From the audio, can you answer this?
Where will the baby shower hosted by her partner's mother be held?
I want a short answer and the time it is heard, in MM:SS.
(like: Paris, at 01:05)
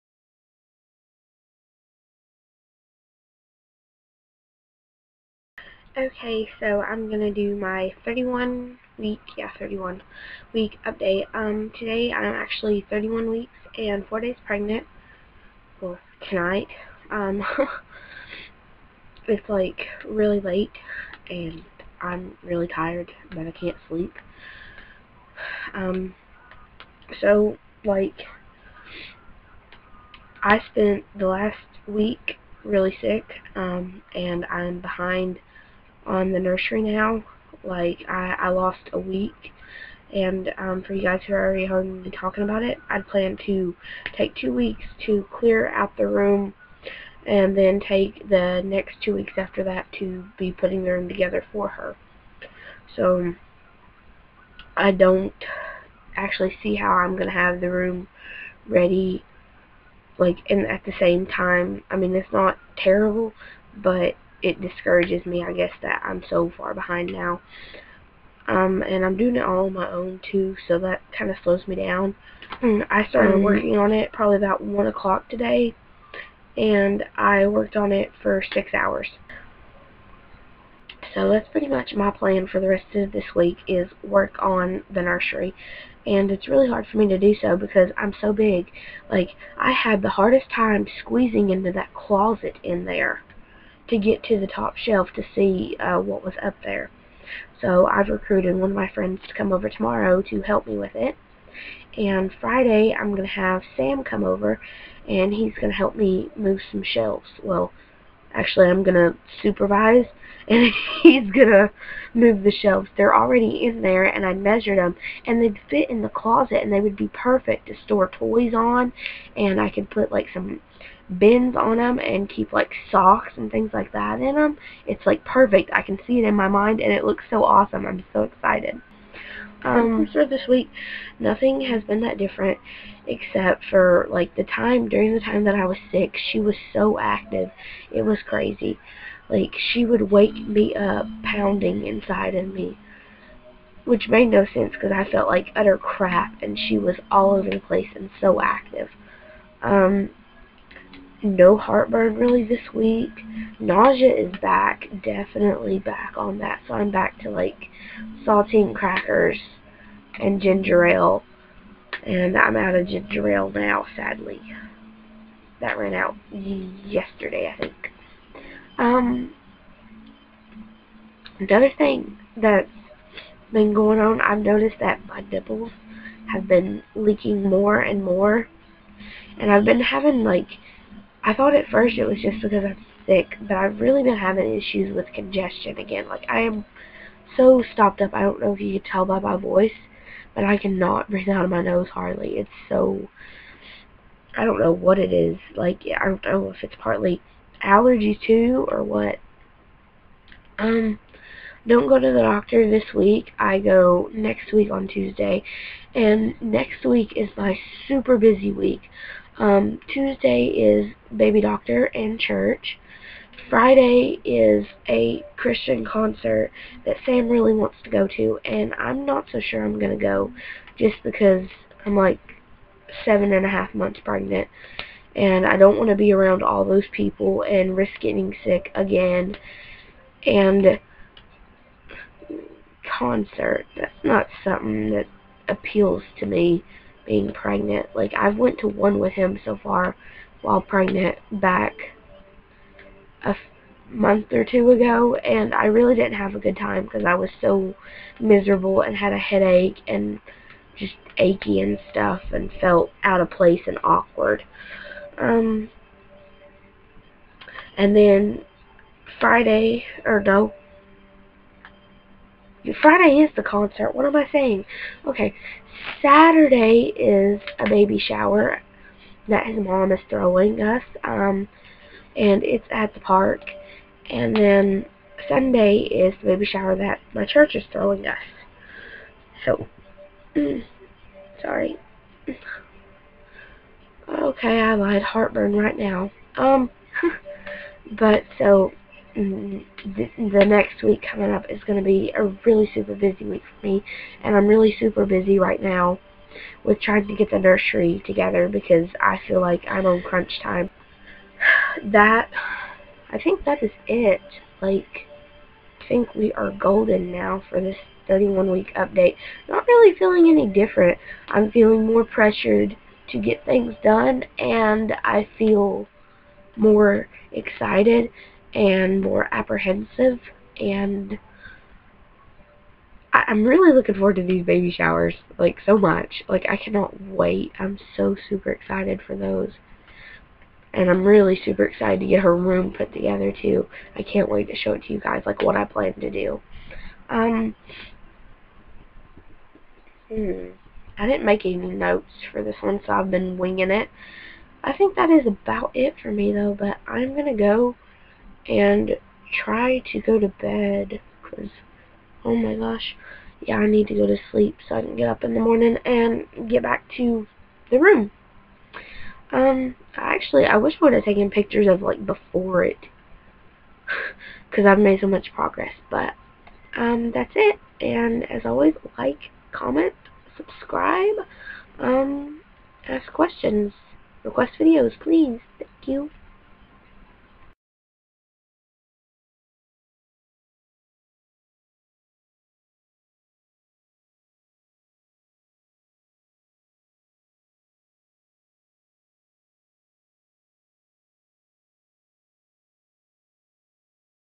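The park, at 04:32.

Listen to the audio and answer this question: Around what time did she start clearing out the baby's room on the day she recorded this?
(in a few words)
1 o'clock.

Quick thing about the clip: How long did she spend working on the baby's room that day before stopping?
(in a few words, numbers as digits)
6 hours.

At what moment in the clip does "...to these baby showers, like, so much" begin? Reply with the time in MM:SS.
05:24.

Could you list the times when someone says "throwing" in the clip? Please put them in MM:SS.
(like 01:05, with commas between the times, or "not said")
04:30, 04:37.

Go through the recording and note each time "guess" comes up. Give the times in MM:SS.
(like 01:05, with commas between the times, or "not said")
01:05.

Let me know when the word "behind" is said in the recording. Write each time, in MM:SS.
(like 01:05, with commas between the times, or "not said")
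00:34, 01:06.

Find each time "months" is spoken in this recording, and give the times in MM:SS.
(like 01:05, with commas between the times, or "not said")
03:43, 04:03.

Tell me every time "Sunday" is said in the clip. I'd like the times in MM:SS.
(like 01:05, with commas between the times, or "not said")
04:35.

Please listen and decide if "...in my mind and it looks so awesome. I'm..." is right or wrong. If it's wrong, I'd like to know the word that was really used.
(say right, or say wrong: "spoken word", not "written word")
right.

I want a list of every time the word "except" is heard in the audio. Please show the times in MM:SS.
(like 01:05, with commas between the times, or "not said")
02:13.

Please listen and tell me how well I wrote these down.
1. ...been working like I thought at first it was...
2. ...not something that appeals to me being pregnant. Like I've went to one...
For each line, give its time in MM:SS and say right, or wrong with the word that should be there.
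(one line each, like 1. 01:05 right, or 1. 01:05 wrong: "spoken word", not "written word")
1. 02:59 wrong: "having", not "working"
2. 03:54 right.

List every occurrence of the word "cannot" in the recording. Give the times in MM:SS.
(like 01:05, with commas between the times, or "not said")
03:10, 05:26.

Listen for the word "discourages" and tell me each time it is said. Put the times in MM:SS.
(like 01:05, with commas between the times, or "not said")
01:04.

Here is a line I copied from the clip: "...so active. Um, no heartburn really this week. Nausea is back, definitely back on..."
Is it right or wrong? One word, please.
right.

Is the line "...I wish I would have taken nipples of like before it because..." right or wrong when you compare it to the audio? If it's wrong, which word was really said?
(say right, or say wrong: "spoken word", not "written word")
wrong: "pictures", not "nipples".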